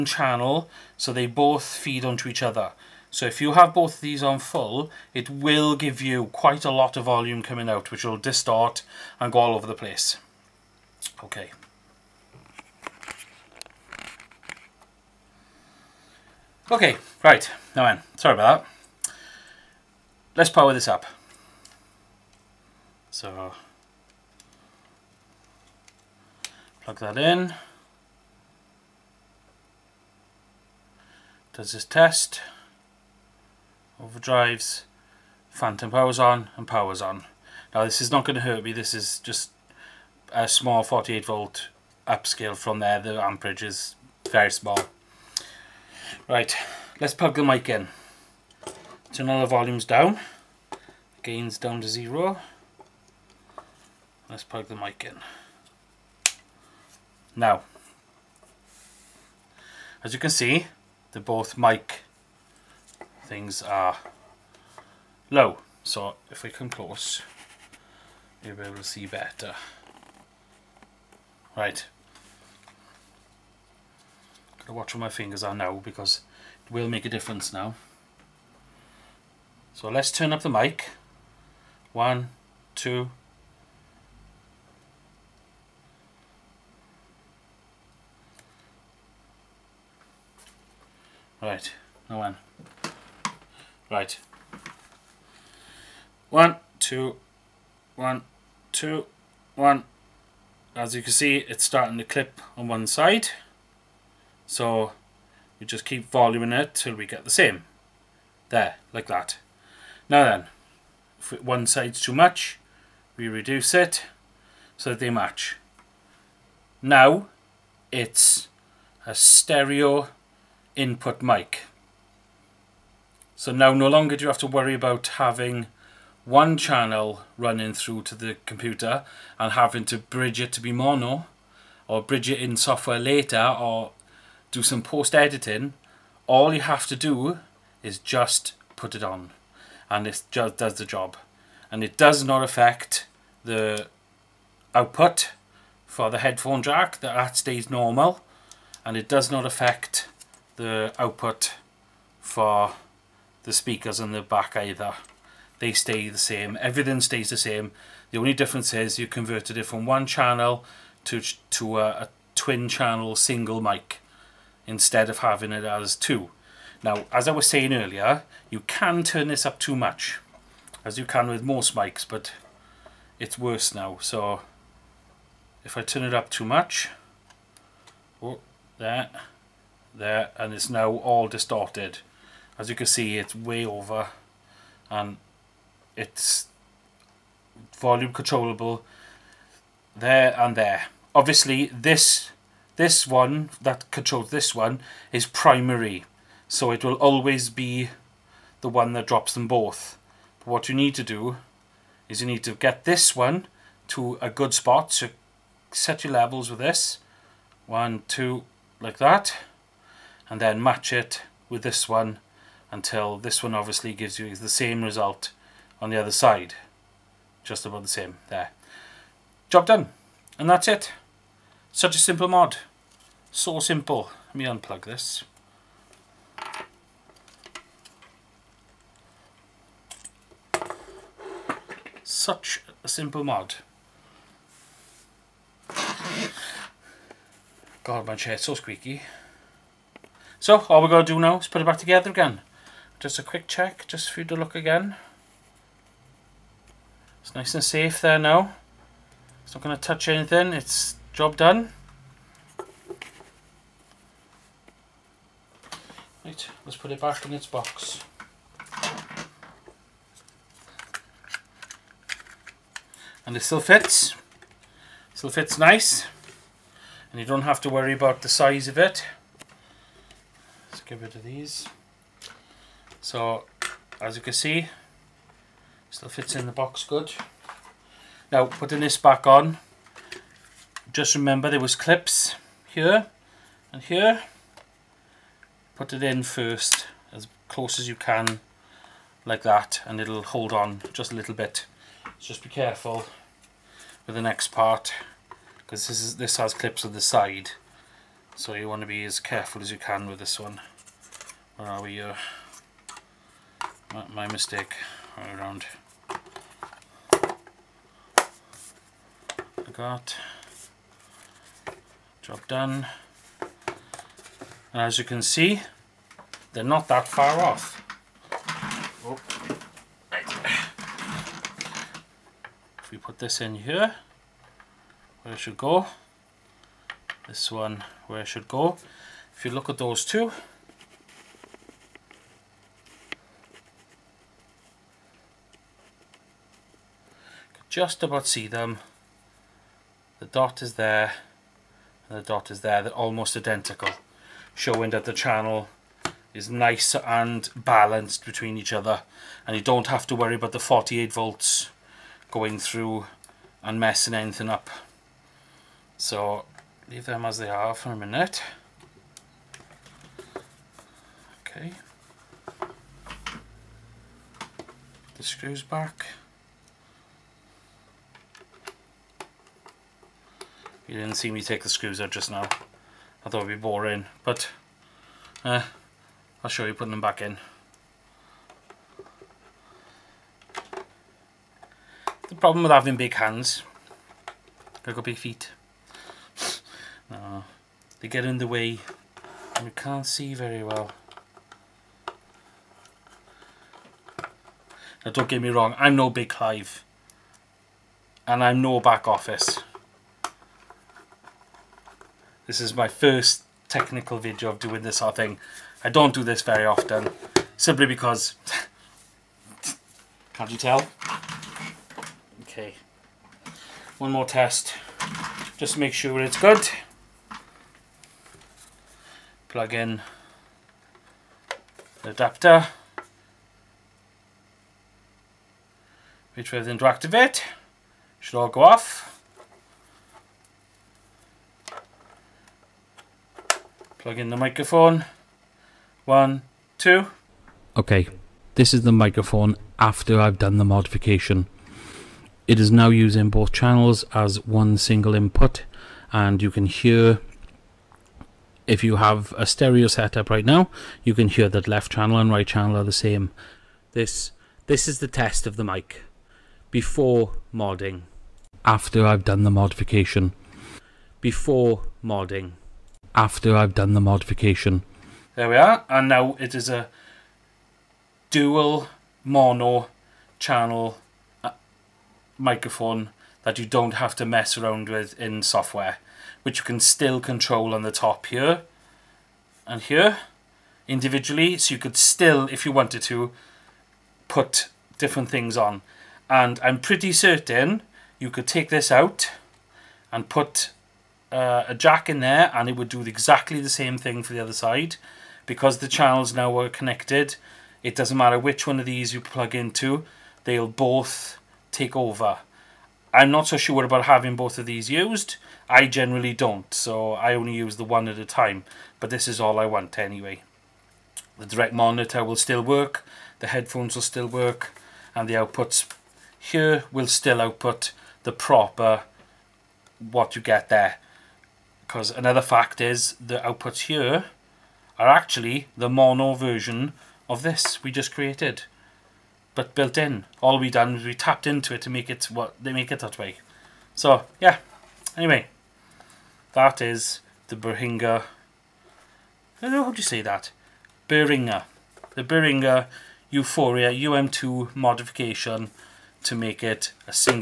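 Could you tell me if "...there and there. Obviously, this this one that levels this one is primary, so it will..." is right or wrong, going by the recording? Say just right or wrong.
wrong.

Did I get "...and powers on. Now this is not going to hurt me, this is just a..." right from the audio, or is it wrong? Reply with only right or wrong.
right.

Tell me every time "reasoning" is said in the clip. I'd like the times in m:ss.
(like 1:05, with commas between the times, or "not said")
not said.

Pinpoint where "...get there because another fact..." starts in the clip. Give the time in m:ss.
8:40.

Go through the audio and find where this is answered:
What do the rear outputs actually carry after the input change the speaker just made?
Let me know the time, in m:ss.
8:45.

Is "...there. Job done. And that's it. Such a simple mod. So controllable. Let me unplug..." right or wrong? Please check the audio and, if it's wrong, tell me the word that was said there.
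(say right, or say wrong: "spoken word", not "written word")
wrong: "simple", not "controllable".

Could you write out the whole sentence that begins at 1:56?
Now, it's a stereo input mic.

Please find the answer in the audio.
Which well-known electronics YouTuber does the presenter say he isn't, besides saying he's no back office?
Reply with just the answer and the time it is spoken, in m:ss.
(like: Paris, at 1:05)
Big Clive, at 6:36.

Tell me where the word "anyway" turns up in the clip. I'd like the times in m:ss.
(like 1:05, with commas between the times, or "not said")
8:29, 8:55.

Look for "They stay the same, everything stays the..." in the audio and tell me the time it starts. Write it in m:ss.
2:35.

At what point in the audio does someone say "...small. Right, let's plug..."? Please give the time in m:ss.
0:44.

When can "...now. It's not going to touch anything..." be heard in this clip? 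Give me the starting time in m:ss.
4:08.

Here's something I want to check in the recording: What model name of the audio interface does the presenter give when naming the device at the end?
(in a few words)
U-Phoria UM2.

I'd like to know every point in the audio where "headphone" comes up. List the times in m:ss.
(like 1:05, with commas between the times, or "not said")
2:26, 8:33.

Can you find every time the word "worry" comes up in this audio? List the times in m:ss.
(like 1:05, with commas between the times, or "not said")
2:04, 4:27, 5:50.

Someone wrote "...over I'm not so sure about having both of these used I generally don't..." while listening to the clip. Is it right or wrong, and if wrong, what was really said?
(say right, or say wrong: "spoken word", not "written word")
right.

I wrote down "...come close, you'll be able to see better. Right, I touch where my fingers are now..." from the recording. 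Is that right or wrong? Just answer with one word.
wrong.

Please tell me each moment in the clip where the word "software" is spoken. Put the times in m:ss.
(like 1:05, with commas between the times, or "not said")
2:12, 7:55.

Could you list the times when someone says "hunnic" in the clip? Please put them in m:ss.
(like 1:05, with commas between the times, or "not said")
not said.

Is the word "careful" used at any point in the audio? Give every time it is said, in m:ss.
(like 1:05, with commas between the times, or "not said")
4:52, 4:59.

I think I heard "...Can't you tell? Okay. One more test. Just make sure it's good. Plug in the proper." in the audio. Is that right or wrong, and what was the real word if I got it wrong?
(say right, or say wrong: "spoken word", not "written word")
wrong: "adapter", not "proper".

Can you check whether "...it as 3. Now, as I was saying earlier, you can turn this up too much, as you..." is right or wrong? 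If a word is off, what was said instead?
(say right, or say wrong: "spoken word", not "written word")
wrong: "2", not "3".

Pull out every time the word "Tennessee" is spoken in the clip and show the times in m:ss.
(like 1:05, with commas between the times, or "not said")
not said.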